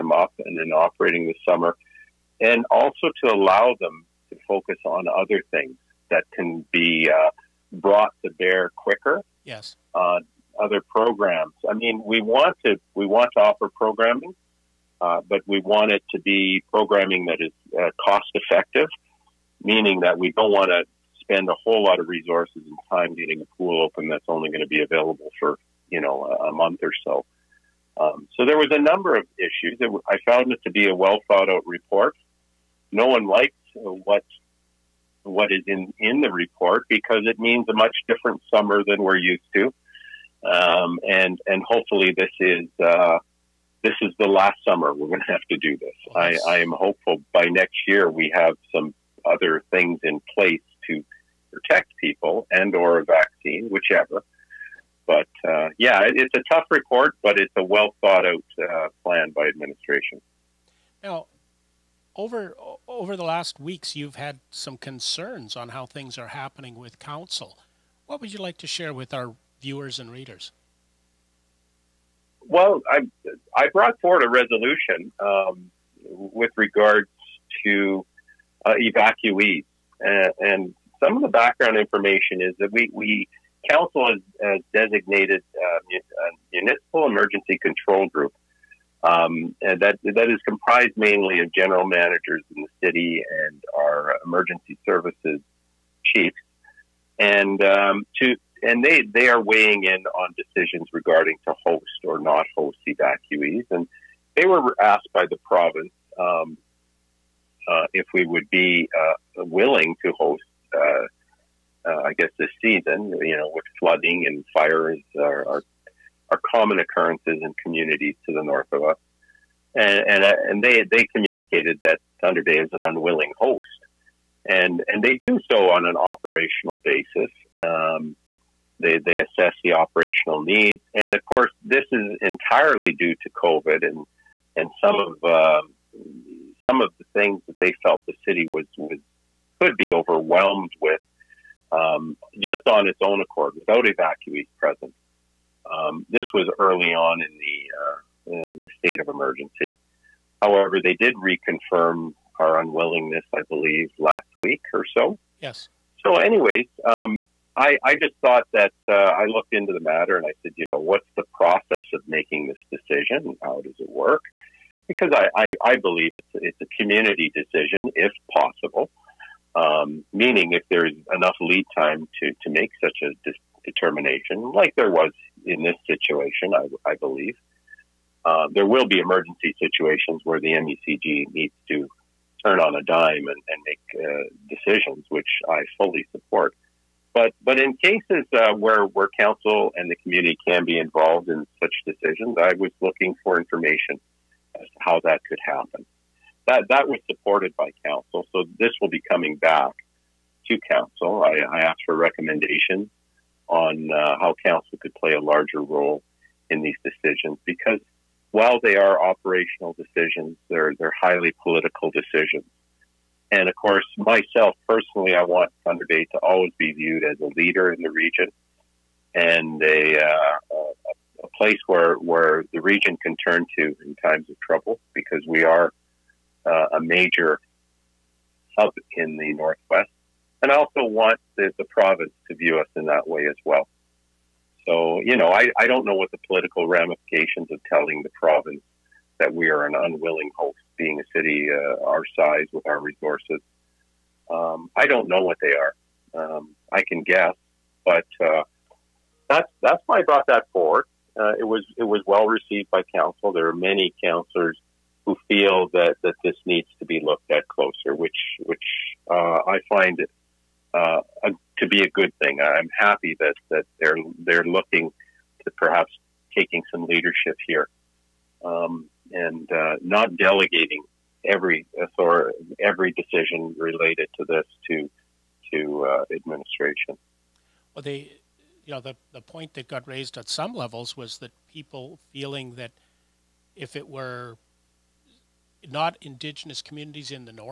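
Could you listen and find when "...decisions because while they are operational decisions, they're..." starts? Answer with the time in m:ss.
3:26.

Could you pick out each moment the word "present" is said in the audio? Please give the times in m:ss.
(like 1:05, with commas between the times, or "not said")
2:24.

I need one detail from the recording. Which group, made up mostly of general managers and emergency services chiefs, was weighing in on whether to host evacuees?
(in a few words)
municipal emergency control group.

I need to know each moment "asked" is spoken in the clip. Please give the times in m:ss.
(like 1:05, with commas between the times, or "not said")
1:44, 3:21.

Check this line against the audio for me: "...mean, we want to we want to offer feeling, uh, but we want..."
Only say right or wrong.
wrong.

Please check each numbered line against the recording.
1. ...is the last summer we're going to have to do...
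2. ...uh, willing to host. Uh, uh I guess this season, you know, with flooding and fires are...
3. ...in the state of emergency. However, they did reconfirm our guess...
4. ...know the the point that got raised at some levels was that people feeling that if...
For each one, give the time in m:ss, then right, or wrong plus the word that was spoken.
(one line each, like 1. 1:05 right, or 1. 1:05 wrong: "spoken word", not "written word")
1. 0:44 right
2. 1:48 right
3. 2:28 wrong: "unwillingness", not "guess"
4. 4:38 right.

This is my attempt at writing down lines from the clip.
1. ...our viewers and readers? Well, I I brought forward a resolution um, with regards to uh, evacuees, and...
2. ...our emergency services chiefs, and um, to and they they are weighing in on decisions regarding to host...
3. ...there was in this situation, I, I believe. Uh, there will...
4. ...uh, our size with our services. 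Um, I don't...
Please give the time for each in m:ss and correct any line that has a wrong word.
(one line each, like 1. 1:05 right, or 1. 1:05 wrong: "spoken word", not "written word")
1. 1:09 right
2. 1:33 right
3. 2:54 right
4. 4:01 wrong: "resources", not "services".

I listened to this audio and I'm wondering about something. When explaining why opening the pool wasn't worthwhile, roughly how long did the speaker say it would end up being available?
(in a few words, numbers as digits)
a month.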